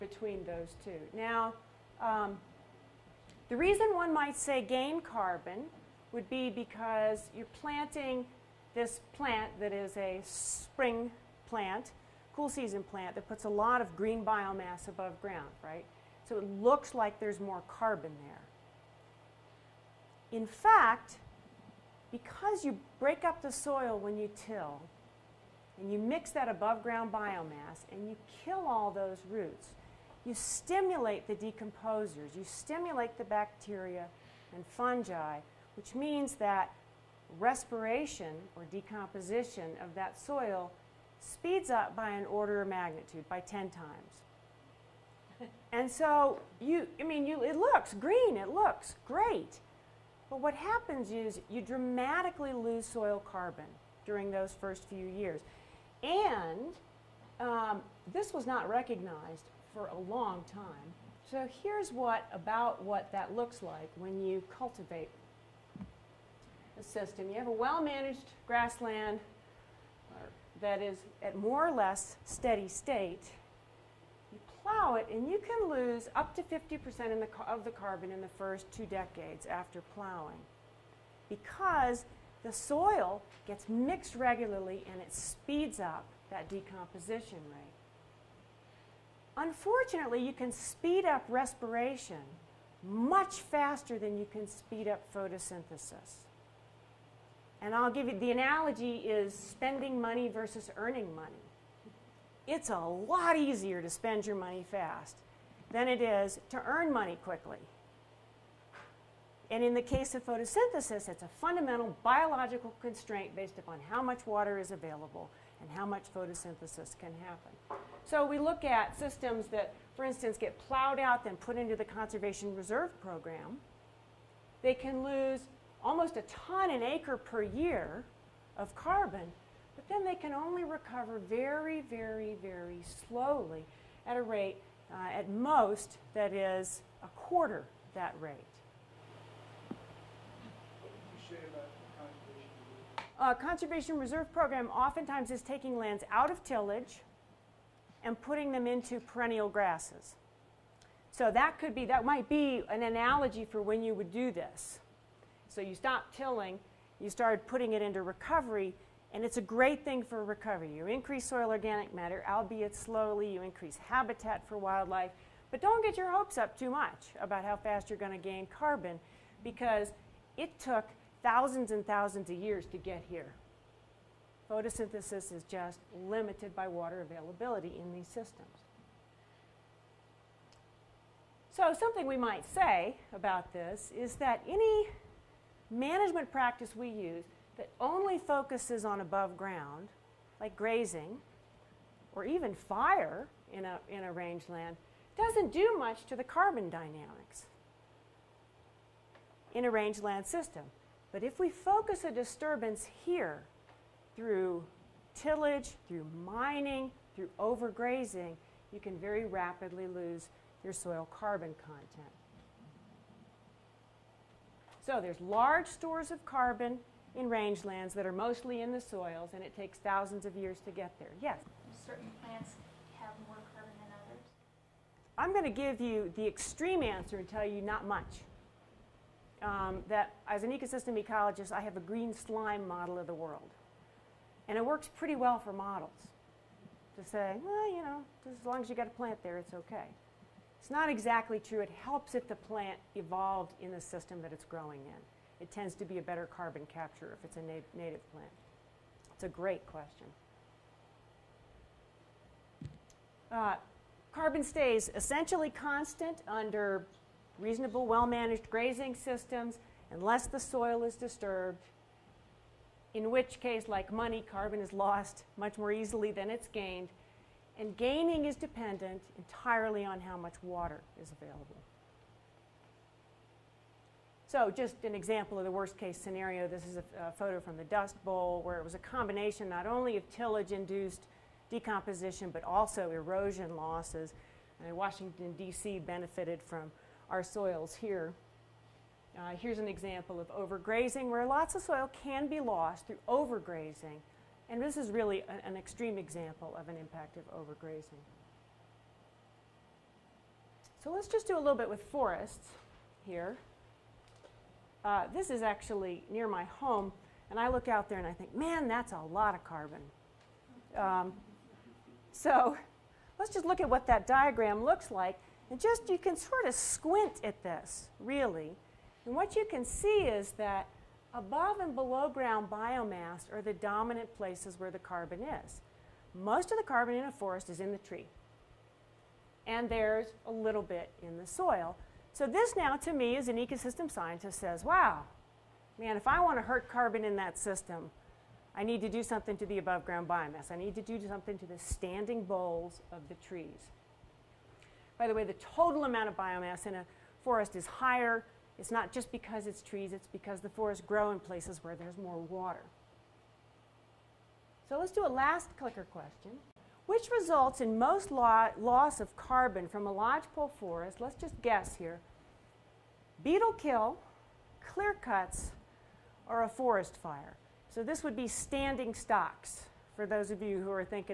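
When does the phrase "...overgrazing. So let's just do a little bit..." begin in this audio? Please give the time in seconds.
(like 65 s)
297 s.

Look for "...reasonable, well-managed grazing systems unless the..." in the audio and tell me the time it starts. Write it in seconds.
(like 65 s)
257 s.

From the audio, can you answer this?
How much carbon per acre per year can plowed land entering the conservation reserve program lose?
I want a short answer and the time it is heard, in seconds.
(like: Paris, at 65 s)
almost a ton, at 125 s.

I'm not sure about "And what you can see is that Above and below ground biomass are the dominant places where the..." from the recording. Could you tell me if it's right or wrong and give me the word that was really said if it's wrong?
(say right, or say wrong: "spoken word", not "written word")
right.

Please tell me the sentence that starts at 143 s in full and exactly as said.
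Uh, conservation reserve program oftentimes is taking lands out of tillage and putting them into perennial grasses.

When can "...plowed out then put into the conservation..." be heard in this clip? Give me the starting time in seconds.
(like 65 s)
120 s.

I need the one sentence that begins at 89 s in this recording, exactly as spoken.
Unfortunately, you can speed up respiration much faster than you can speed up photosynthesis.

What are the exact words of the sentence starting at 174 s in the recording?
Photosynthesis is just limited by water availability in these systems.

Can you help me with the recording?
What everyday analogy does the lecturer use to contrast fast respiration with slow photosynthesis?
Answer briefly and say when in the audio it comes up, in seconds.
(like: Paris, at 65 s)
spending money versus earning money, at 99 s.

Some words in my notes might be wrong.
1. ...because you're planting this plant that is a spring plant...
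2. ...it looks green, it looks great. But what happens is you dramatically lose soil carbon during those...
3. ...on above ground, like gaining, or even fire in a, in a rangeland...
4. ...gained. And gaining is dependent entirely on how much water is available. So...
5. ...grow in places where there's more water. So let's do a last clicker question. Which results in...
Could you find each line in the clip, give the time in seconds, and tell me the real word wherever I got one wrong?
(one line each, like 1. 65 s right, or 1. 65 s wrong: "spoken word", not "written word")
1. 6 s right
2. 47 s right
3. 188 s wrong: "grazing", not "gaining"
4. 266 s right
5. 350 s right.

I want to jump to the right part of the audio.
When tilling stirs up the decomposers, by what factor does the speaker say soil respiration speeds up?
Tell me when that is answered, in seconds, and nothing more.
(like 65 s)
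43 s.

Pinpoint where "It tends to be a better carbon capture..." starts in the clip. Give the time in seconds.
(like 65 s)
245 s.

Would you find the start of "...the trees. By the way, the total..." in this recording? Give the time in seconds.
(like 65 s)
343 s.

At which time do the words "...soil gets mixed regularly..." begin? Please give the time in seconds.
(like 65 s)
82 s.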